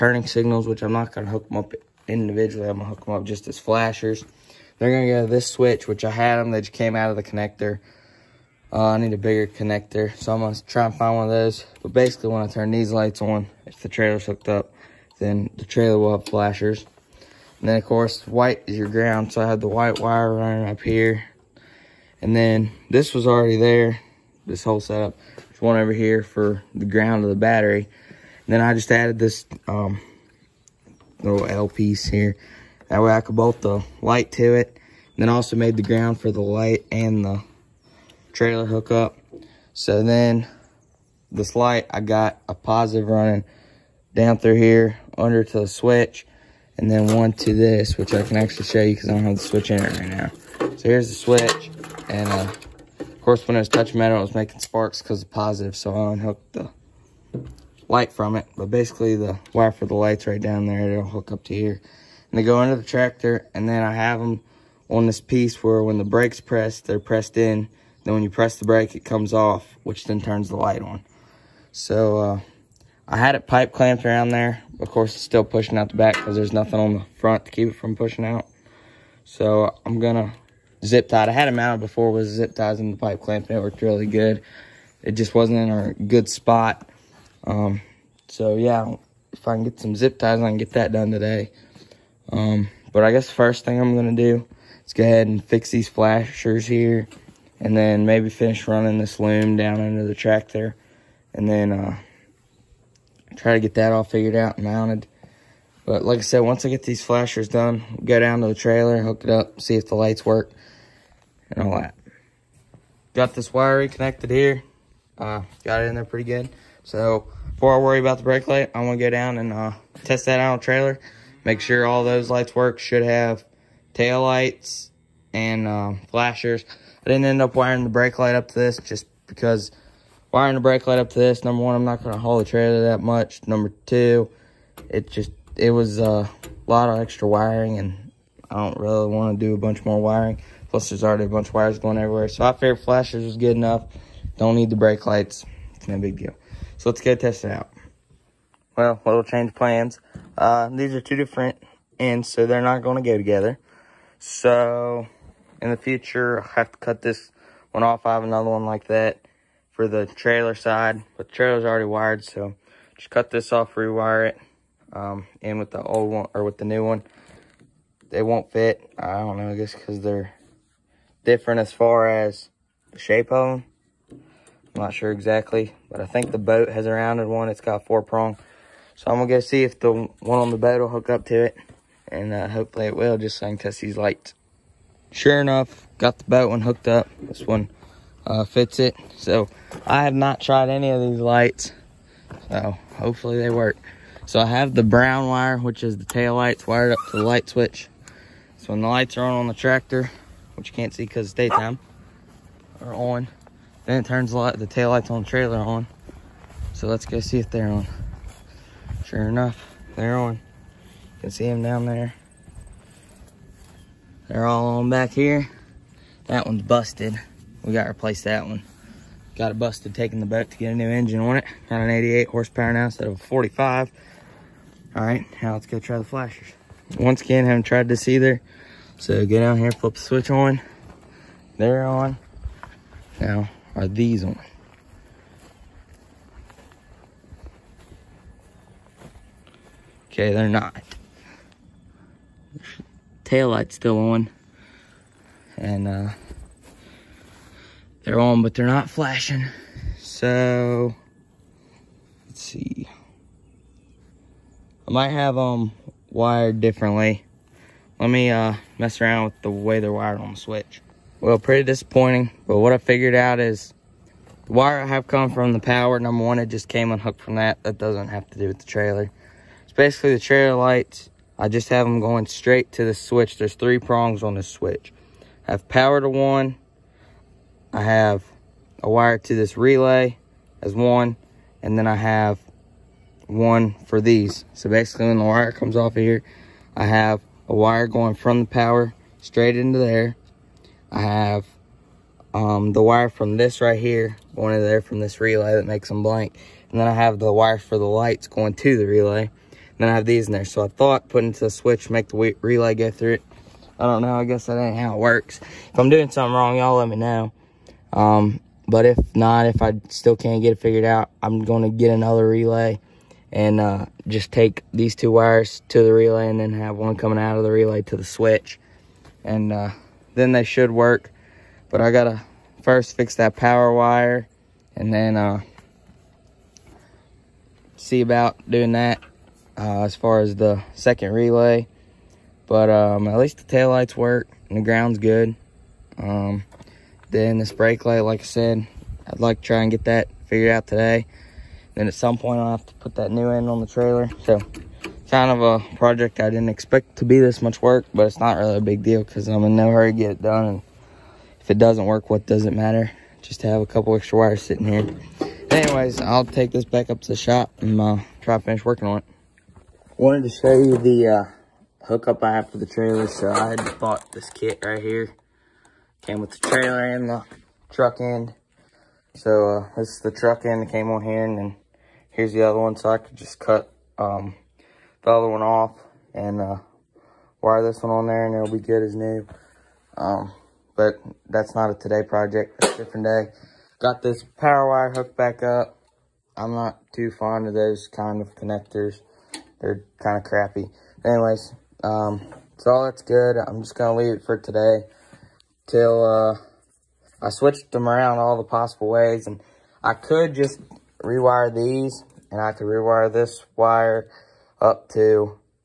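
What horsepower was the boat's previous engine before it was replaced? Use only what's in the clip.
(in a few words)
45.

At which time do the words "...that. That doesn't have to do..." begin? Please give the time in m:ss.
4:27.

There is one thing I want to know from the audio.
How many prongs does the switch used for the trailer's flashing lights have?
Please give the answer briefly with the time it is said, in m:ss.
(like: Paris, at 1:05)
3, at 4:33.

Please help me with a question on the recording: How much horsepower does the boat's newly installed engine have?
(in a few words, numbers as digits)
88.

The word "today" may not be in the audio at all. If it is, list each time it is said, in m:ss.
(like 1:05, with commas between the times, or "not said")
1:31, 5:40, 6:21, 6:34.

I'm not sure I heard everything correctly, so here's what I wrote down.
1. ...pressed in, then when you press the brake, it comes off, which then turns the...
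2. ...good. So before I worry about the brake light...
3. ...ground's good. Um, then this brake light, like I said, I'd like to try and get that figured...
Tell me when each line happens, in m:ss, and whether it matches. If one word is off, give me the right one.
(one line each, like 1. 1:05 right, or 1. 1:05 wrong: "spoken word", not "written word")
1. 1:06 right
2. 1:56 right
3. 5:34 right.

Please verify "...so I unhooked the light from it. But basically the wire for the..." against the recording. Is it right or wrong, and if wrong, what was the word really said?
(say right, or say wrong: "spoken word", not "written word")
right.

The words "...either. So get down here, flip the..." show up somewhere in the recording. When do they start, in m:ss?
3:48.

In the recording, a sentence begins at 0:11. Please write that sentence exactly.
But basically, when I turn these lights on, if the trailer's hooked up, then the trailer will have flashers.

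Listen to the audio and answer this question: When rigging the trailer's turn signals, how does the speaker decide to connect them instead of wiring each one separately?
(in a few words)
As flashers.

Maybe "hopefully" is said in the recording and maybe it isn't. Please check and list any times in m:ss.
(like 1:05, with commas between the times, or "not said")
3:02, 3:12.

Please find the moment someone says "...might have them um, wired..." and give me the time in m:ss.
4:14.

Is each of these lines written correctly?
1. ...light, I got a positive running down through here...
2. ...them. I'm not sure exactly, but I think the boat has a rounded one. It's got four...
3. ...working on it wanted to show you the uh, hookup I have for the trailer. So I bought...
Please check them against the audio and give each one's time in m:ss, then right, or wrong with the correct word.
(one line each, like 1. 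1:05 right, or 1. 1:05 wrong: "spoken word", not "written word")
1. 0:41 right
2. 2:53 right
3. 5:58 right.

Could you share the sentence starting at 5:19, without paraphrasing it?
And uh, then they should work.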